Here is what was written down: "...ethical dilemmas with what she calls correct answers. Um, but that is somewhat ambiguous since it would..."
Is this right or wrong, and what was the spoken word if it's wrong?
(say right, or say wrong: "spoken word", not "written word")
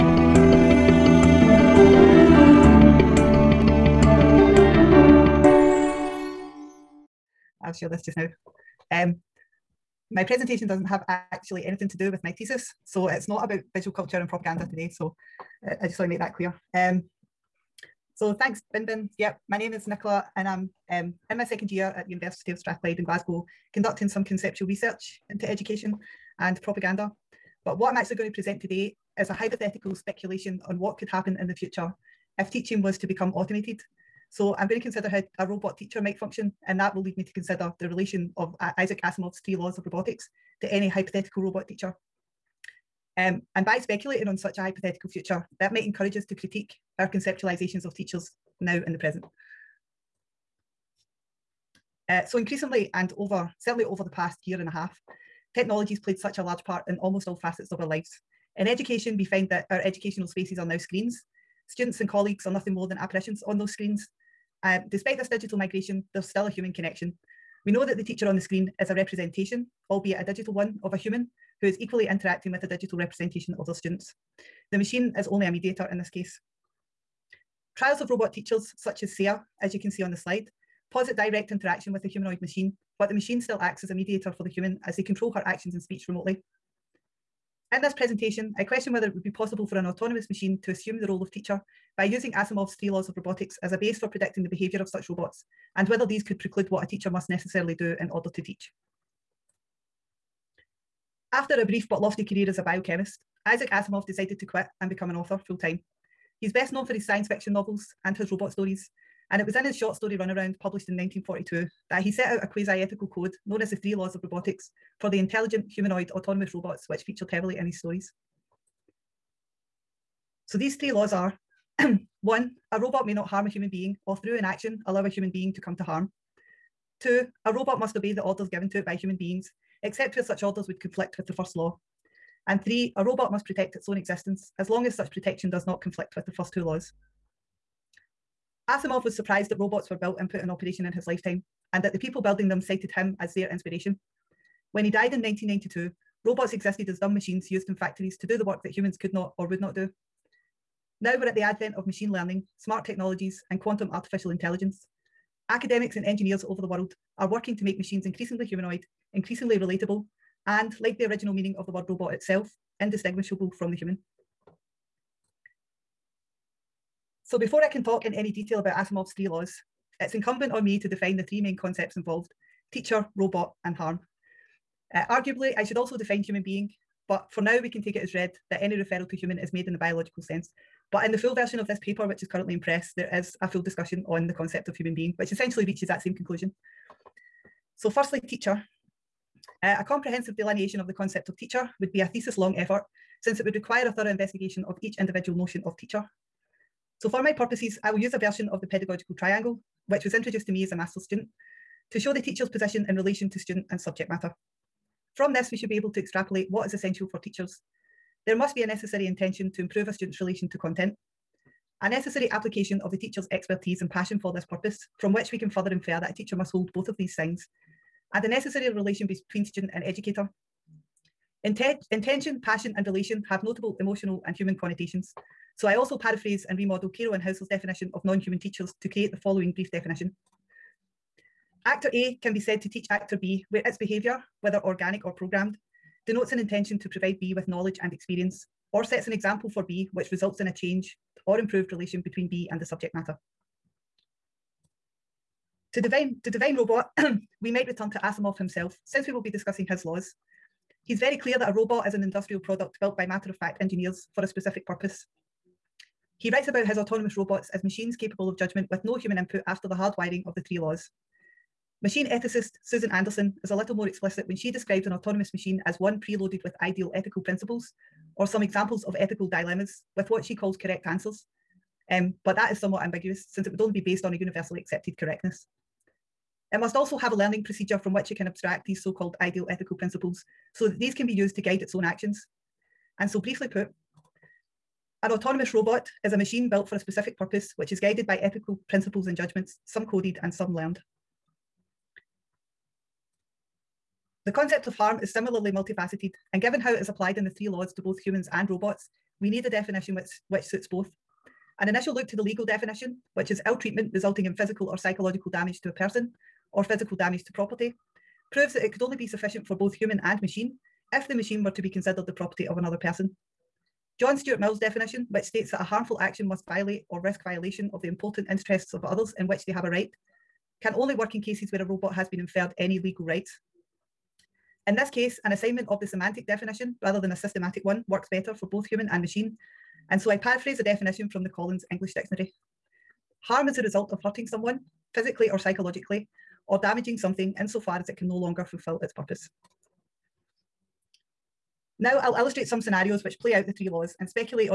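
right.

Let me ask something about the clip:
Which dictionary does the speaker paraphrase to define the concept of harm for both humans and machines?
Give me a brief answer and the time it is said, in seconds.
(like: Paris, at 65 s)
Collins English Dictionary, at 331 s.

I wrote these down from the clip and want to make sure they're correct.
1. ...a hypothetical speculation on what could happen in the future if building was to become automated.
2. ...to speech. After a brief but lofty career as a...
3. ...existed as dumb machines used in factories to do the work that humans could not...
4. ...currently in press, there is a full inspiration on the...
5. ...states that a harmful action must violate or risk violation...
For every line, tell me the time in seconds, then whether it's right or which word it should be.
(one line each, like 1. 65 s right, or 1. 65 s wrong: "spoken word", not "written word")
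1. 29 s wrong: "teaching", not "building"
2. 98 s wrong: "teach", not "speech"
3. 146 s right
4. 182 s wrong: "discussion", not "inspiration"
5. 315 s right.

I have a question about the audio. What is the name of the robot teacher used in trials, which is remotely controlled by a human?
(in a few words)
SAIR.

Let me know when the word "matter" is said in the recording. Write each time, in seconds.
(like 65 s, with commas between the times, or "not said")
204 s, 242 s, 253 s.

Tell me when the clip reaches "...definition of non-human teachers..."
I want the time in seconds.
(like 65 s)
227 s.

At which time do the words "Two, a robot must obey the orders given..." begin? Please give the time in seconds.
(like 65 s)
126 s.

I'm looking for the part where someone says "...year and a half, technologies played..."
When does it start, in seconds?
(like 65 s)
54 s.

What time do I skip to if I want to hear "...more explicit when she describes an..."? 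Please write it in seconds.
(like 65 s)
263 s.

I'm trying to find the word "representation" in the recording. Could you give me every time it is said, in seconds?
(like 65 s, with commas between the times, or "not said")
68 s, 72 s.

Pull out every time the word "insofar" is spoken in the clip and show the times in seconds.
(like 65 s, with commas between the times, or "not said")
337 s.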